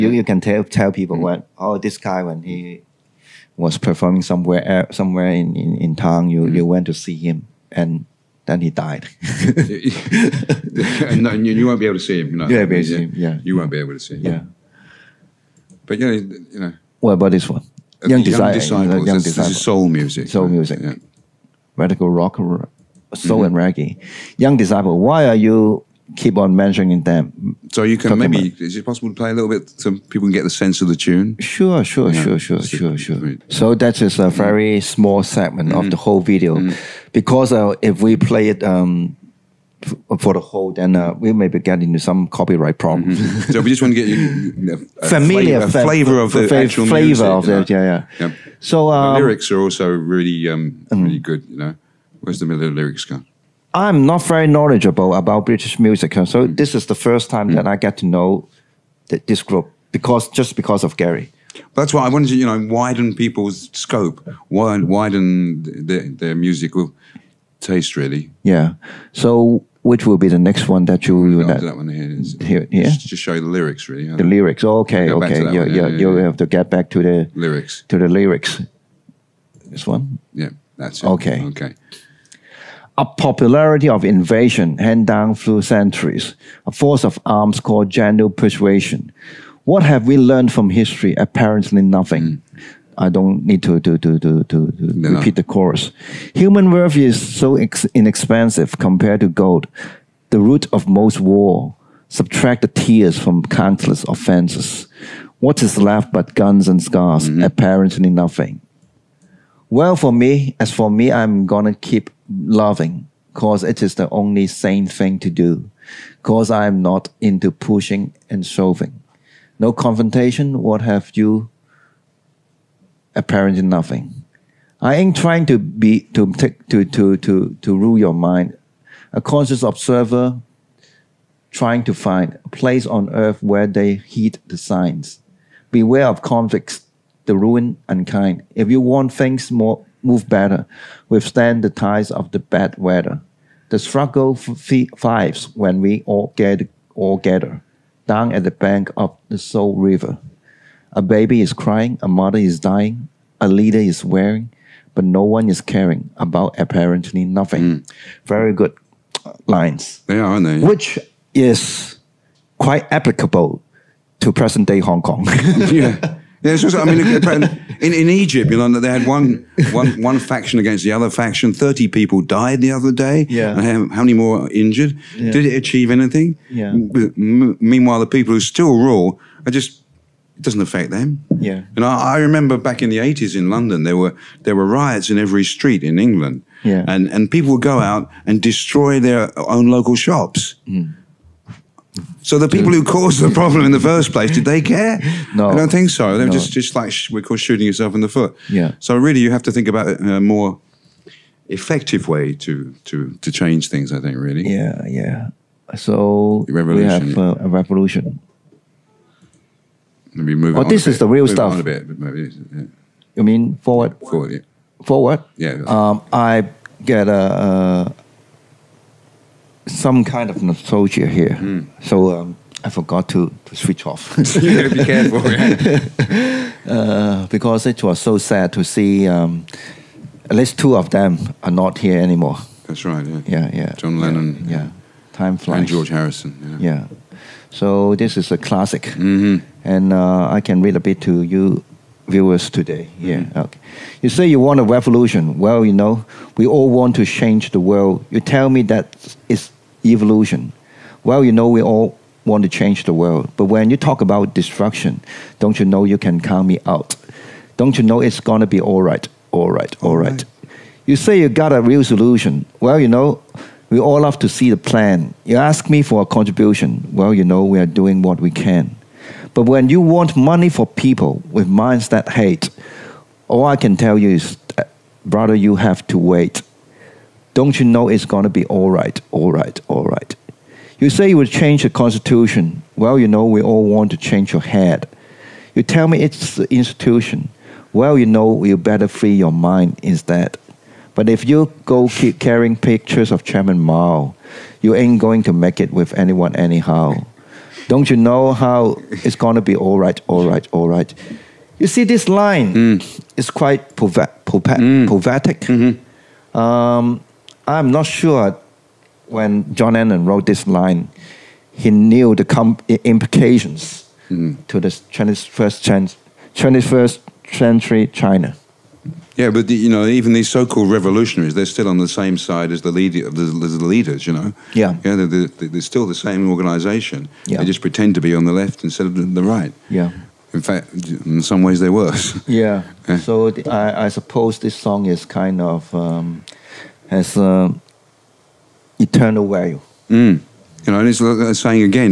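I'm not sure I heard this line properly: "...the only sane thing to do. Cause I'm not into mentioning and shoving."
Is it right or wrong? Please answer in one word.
wrong.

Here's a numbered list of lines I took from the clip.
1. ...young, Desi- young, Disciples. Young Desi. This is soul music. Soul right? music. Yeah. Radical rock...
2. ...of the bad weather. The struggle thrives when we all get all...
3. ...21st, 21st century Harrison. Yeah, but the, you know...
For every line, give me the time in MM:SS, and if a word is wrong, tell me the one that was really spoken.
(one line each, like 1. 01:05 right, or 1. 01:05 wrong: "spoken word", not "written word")
1. 00:18 wrong: "Disciples", not "Desi"
2. 02:22 right
3. 05:14 wrong: "China", not "Harrison".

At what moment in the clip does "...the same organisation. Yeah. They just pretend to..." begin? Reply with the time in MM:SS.
05:25.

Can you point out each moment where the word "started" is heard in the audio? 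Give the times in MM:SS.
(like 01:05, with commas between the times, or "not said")
not said.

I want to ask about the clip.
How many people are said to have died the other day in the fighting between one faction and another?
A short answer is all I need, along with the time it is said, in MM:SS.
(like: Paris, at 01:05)
30, at 02:51.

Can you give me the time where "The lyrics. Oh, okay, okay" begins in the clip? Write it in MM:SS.
01:14.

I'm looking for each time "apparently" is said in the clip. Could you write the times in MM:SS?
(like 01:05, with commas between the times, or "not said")
01:31, 01:47, 02:03, 02:36.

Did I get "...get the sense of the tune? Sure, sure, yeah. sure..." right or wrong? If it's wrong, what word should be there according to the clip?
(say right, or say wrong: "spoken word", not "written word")
right.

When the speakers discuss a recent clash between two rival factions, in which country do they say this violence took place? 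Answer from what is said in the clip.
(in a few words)
Egypt.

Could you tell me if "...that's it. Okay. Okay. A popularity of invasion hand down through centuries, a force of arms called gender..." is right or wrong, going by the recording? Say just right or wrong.
right.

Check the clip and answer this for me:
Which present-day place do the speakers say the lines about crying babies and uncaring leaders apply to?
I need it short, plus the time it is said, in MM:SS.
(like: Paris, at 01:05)
Hong Kong, at 02:44.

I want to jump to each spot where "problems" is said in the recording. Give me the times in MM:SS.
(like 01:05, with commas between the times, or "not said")
00:42, 03:13.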